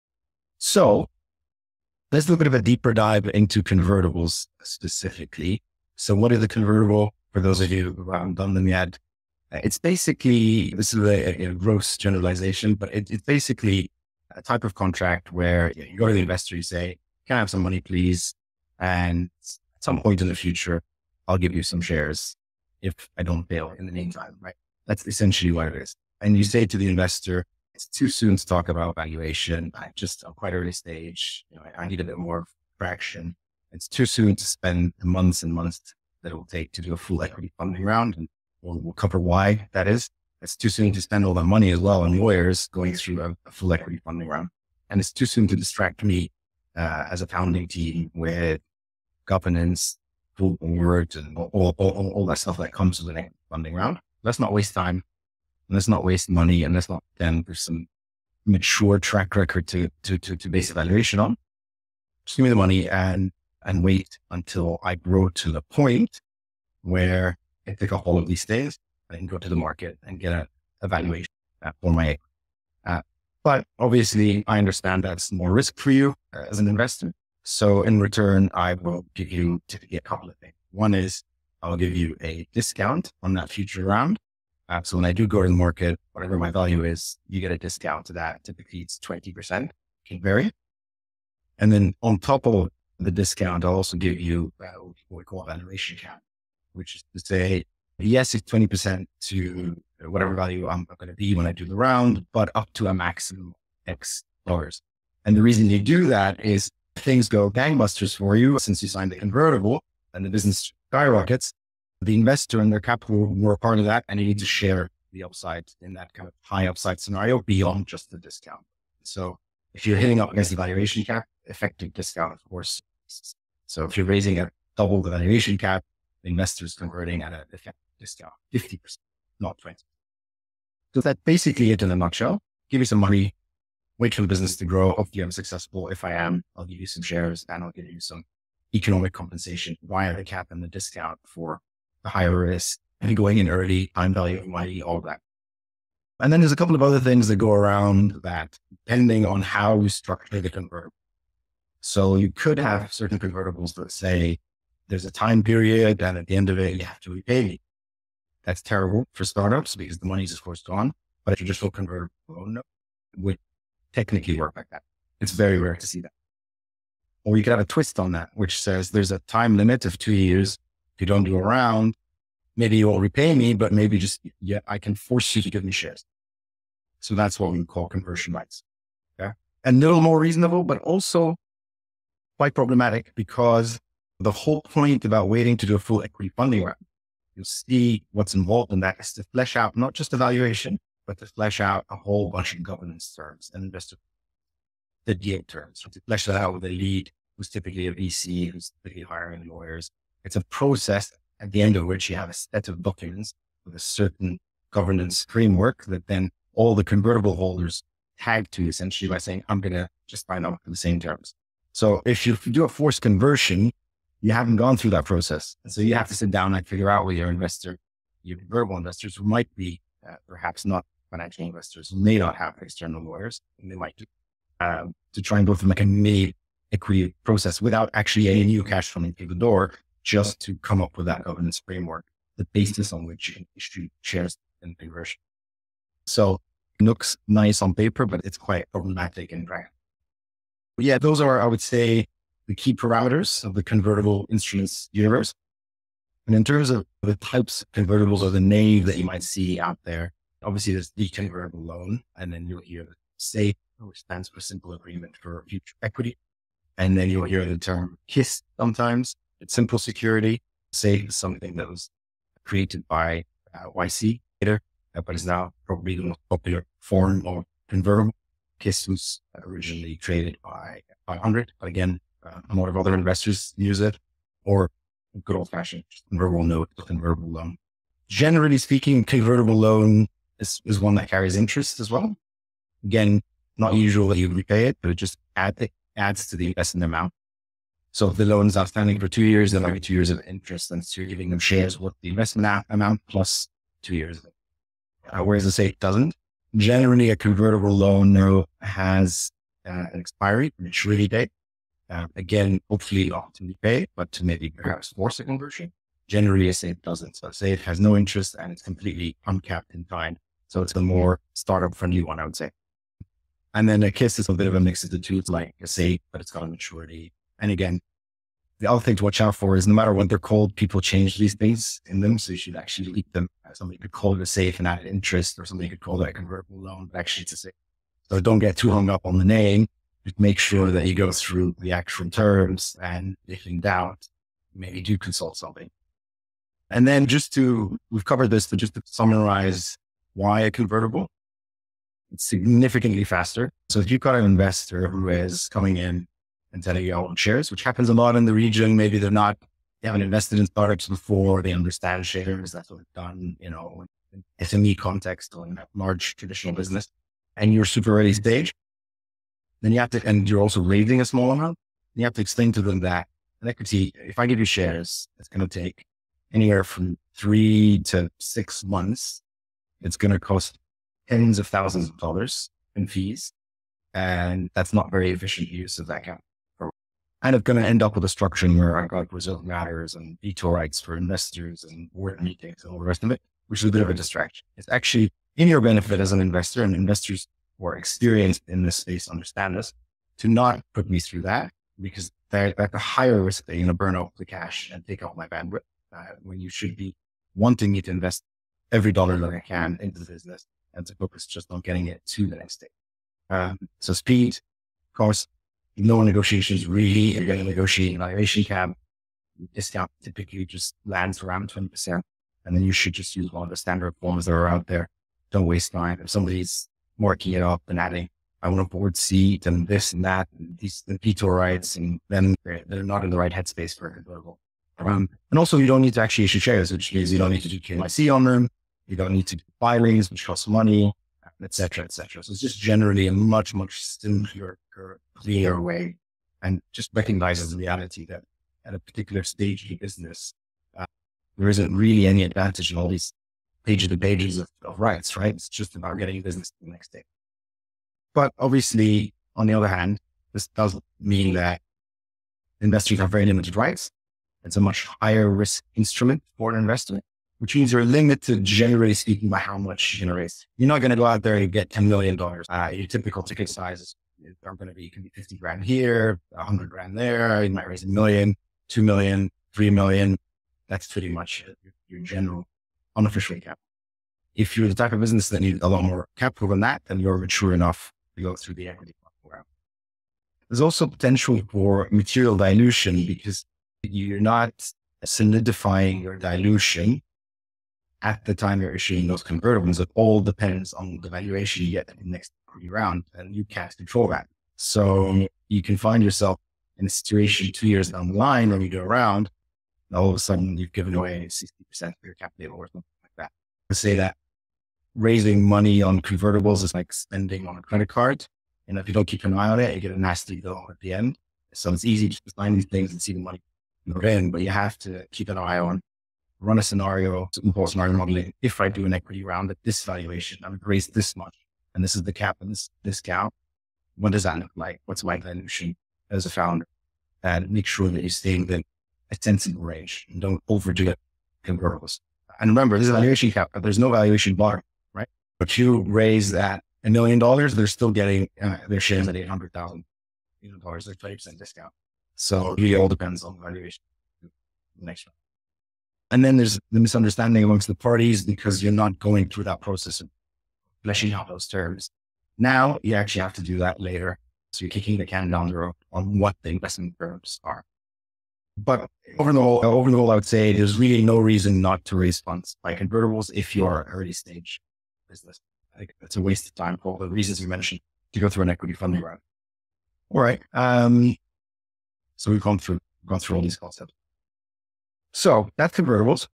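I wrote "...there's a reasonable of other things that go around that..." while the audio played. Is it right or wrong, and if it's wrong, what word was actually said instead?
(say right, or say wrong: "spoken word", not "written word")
wrong: "couple", not "reasonable".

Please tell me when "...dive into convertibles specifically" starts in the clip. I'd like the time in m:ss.
0:02.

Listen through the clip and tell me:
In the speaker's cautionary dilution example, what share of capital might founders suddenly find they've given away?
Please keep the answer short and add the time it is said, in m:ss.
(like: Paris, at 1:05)
60%, at 8:21.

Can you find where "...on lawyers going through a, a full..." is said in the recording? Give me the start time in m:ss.
0:42.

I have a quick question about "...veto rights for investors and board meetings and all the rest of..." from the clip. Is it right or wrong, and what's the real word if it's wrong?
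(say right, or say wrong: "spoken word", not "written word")
right.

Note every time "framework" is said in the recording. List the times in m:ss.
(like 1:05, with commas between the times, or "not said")
3:25, 3:51.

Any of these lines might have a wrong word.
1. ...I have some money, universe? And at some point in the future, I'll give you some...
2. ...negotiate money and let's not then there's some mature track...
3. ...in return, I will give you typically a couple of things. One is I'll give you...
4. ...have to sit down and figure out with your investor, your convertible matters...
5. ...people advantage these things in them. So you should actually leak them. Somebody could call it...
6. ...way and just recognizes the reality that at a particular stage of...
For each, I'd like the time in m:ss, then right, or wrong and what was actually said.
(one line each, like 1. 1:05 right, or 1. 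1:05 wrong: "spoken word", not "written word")
1. 0:17 wrong: "please", not "universe"
2. 0:56 wrong: "waste", not "negotiate"
3. 1:17 right
4. 3:35 wrong: "investors", not "matters"
5. 5:20 wrong: "change", not "advantage"
6. 7:15 right.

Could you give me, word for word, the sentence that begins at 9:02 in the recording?
So it all depends on valuation.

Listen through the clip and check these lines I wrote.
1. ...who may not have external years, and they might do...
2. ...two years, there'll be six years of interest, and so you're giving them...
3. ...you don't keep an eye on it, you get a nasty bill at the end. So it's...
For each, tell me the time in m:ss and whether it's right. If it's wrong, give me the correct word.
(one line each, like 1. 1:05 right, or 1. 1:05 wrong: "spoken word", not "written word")
1. 3:41 wrong: "lawyers", not "years"
2. 4:49 wrong: "two", not "six"
3. 8:28 right.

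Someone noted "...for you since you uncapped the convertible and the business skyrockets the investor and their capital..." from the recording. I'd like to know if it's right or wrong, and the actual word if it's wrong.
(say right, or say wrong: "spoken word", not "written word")
wrong: "signed", not "uncapped".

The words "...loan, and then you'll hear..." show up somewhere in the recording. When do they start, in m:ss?
4:11.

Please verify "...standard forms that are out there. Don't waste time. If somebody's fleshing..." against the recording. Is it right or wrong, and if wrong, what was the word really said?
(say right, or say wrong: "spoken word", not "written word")
wrong: "marking", not "fleshing".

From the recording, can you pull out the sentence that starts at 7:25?
It's just about getting business the next day.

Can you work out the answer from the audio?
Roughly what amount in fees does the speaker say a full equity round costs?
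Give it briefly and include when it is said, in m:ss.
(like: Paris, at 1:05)
tens of thousands of dollars, at 6:11.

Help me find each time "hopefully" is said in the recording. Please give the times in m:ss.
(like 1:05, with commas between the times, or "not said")
2:14, 5:02.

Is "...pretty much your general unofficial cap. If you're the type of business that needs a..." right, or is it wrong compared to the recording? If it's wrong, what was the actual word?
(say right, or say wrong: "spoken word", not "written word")
right.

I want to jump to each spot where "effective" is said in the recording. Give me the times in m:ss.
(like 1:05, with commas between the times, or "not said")
2:01, 2:07.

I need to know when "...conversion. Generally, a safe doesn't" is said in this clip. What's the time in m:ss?
5:05.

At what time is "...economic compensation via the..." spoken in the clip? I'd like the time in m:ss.
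2:18.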